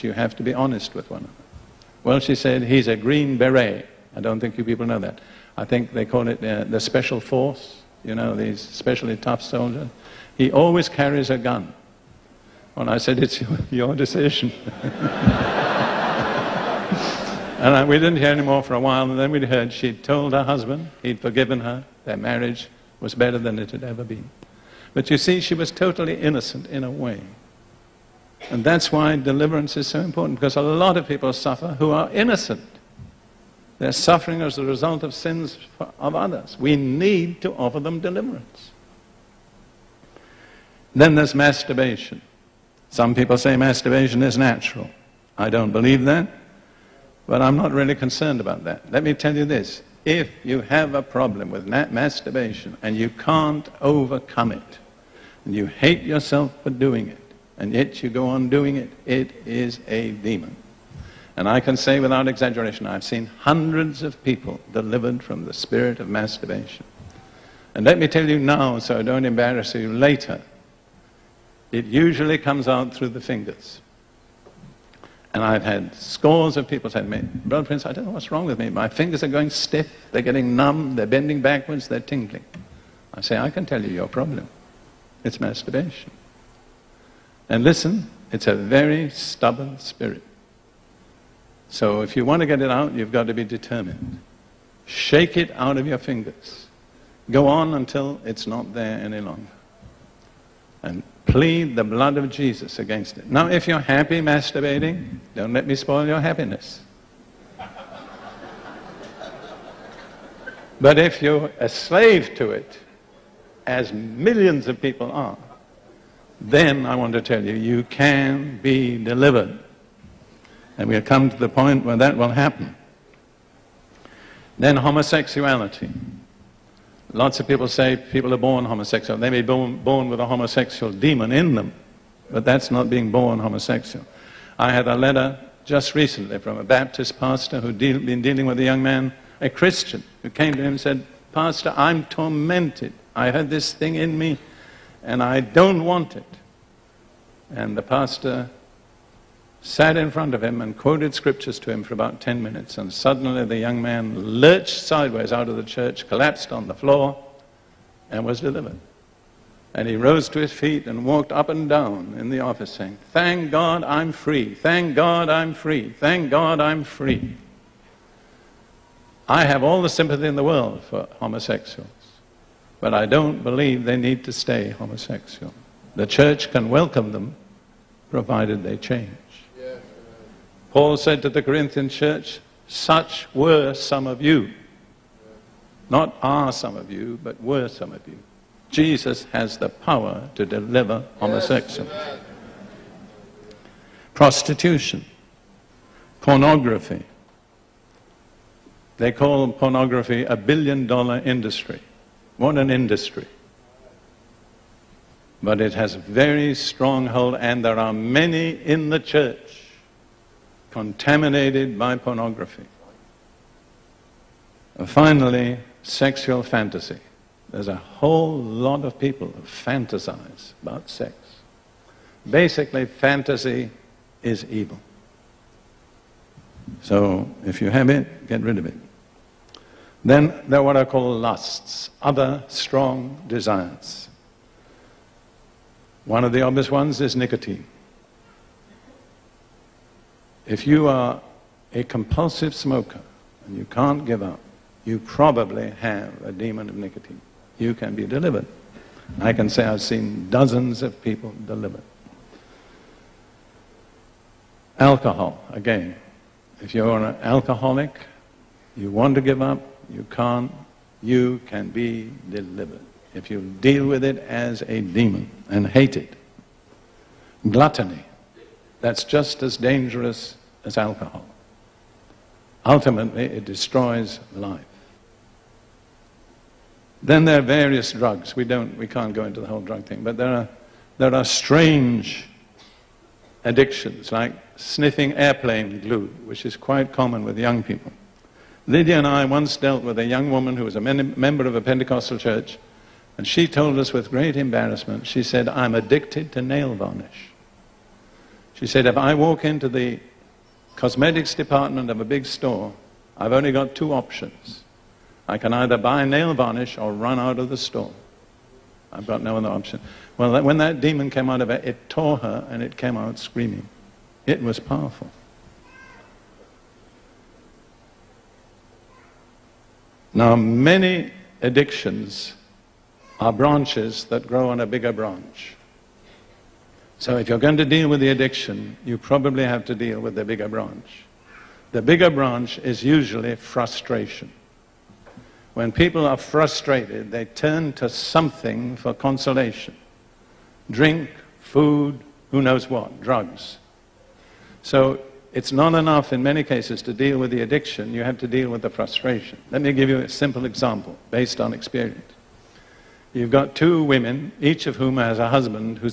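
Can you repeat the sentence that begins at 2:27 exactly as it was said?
And the pastor sat in front of him and quoted scriptures to him for about 10 minutes.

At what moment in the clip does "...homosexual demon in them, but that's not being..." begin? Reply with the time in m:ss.
2:10.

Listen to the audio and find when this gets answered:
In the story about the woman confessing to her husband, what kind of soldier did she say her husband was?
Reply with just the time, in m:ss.
0:02.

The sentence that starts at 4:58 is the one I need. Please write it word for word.
She said, if I walk into the cosmetics department of a big store, I've only got two options.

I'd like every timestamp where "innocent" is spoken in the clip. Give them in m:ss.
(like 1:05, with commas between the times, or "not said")
0:26, 0:32.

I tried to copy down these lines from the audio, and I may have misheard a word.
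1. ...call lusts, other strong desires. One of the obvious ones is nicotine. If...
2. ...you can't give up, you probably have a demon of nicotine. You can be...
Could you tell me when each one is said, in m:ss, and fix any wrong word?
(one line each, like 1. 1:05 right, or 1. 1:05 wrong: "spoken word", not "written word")
1. 3:50 right
2. 4:03 right.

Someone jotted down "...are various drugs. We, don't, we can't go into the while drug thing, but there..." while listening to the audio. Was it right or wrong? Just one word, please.
wrong.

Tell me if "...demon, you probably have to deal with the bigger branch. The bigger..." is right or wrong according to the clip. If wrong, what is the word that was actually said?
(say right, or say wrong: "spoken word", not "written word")
wrong: "addiction", not "demon".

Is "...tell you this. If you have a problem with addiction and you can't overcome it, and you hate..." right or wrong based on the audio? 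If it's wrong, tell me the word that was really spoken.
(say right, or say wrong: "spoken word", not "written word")
wrong: "masturbation", not "addiction".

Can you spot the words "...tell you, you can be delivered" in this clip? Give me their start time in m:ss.
1:57.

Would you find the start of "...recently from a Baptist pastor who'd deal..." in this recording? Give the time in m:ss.
2:15.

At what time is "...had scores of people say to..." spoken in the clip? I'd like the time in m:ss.
1:15.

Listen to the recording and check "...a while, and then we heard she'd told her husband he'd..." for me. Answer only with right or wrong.
right.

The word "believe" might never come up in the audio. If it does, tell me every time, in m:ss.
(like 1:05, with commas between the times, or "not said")
0:45, 2:53.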